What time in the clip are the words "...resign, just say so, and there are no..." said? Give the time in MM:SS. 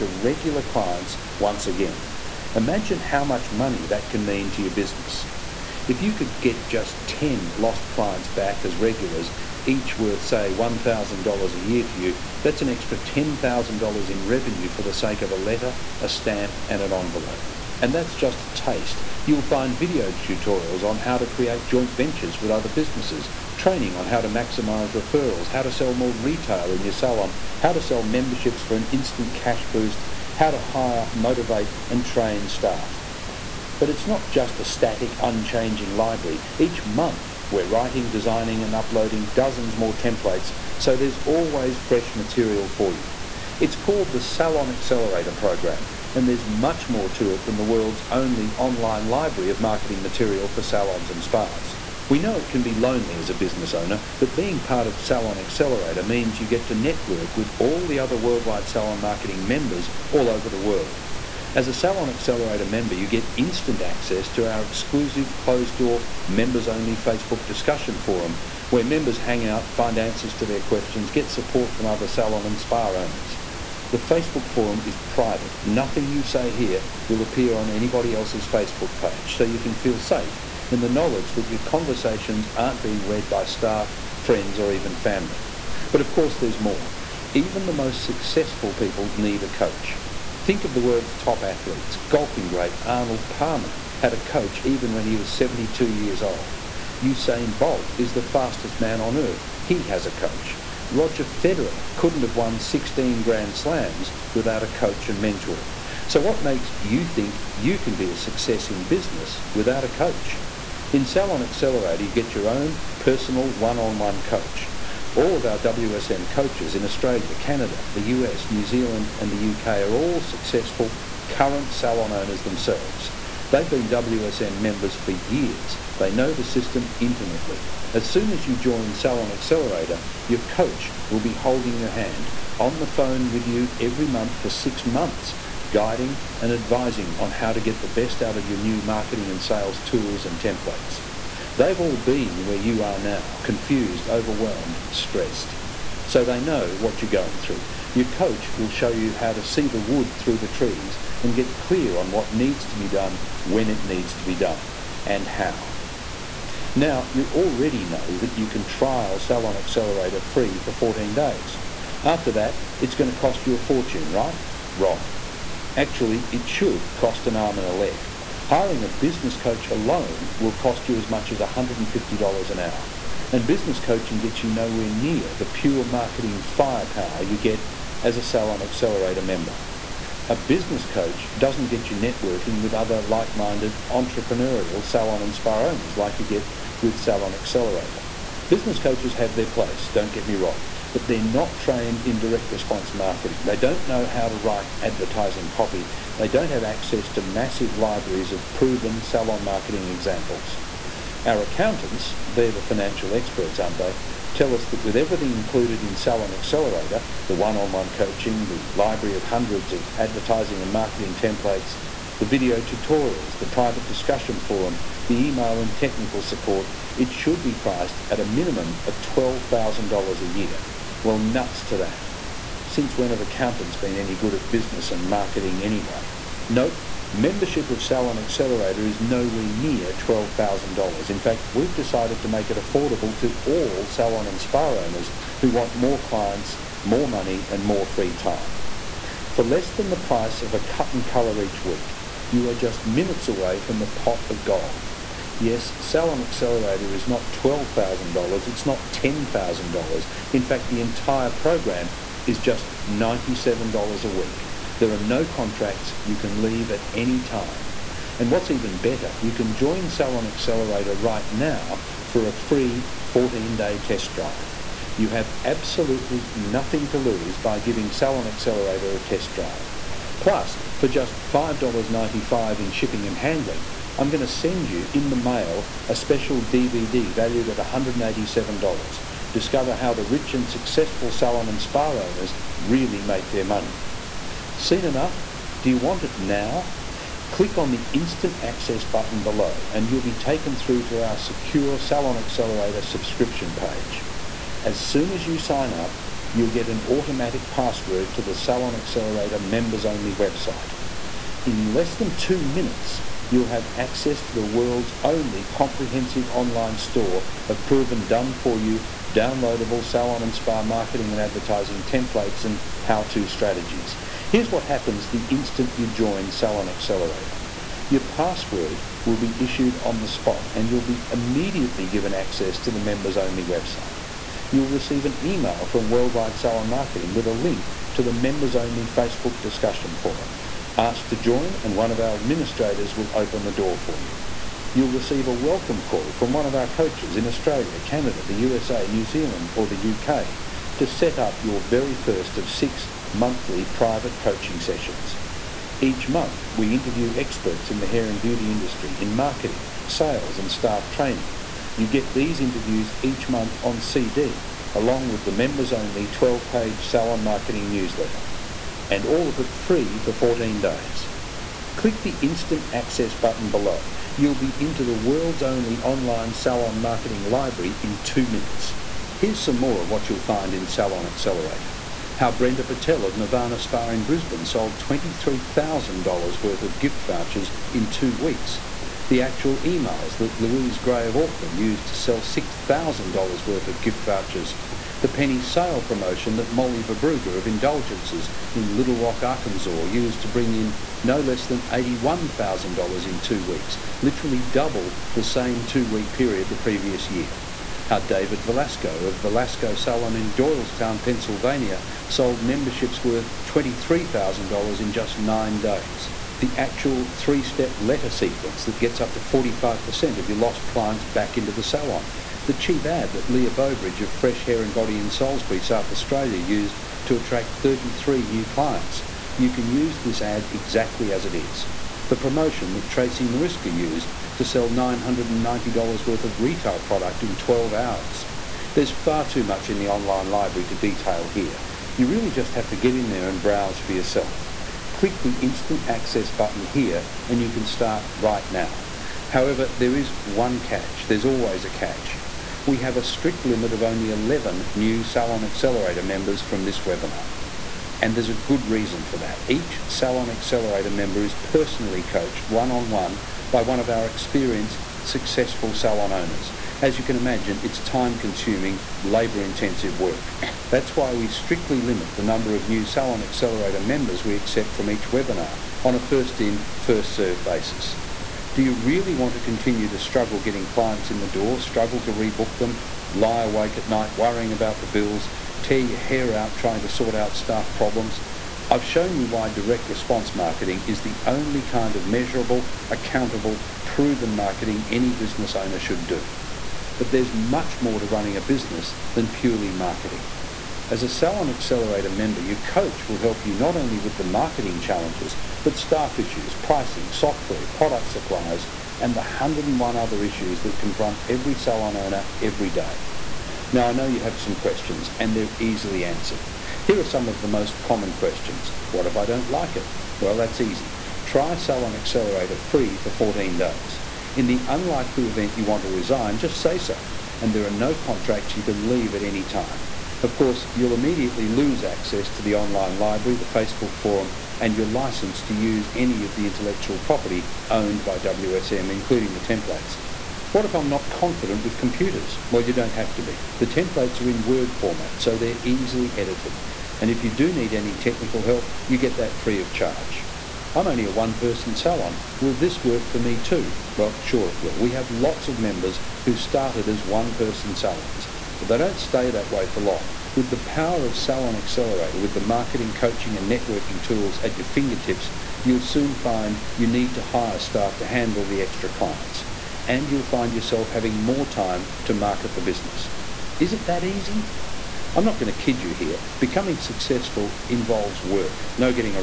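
08:35.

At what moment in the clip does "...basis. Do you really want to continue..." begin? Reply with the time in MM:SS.
07:47.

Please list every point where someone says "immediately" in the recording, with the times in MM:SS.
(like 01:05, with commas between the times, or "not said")
05:21, 08:40.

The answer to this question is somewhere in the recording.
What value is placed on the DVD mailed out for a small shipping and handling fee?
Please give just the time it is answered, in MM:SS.
04:37.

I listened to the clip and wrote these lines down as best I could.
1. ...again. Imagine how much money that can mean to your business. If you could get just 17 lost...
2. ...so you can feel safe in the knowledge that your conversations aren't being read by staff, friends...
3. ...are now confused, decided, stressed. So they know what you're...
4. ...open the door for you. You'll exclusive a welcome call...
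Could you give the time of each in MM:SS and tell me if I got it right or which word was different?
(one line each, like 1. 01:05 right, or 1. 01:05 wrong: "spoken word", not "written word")
1. 00:01 wrong: "10", not "17"
2. 01:19 right
3. 02:22 wrong: "overwhelmed", not "decided"
4. 05:33 wrong: "receive", not "exclusive".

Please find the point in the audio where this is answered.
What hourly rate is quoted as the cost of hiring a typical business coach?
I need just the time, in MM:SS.
02:51.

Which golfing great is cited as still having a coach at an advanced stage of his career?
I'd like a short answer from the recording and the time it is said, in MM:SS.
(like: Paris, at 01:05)
Arnold Palmer, at 01:32.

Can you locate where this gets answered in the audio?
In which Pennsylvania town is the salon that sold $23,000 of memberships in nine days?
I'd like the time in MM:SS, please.
06:40.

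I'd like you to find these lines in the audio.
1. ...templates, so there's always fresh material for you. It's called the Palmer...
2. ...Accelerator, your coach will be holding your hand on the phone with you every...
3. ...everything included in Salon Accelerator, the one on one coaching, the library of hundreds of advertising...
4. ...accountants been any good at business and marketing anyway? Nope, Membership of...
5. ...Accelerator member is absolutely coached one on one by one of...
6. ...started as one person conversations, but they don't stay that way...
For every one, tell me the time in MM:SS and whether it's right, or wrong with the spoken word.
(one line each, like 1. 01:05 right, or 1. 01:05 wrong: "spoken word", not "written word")
1. 00:39 wrong: "Salon", not "Palmer"
2. 02:09 right
3. 03:24 right
4. 03:43 right
5. 07:30 wrong: "personally", not "absolutely"
6. 09:06 wrong: "salons", not "conversations".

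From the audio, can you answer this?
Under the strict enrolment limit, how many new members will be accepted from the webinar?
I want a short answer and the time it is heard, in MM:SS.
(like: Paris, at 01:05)
11, at 07:24.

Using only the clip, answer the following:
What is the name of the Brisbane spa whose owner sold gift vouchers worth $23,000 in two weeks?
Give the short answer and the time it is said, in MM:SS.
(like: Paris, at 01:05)
Nirvana Spa, at 06:13.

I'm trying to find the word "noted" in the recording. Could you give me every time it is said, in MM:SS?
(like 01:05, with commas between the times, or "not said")
not said.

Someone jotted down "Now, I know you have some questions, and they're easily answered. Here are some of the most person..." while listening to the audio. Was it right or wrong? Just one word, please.
wrong.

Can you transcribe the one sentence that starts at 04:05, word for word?
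Yes, Salon Accelerator is not $12,000, it's not $10,000.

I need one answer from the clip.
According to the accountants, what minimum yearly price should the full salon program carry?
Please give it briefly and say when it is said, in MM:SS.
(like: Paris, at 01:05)
$12,000, at 03:39.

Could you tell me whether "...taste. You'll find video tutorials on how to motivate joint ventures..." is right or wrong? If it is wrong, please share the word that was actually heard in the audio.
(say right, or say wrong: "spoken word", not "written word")
wrong: "create", not "motivate".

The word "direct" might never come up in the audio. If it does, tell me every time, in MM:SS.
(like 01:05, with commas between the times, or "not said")
03:12, 07:59.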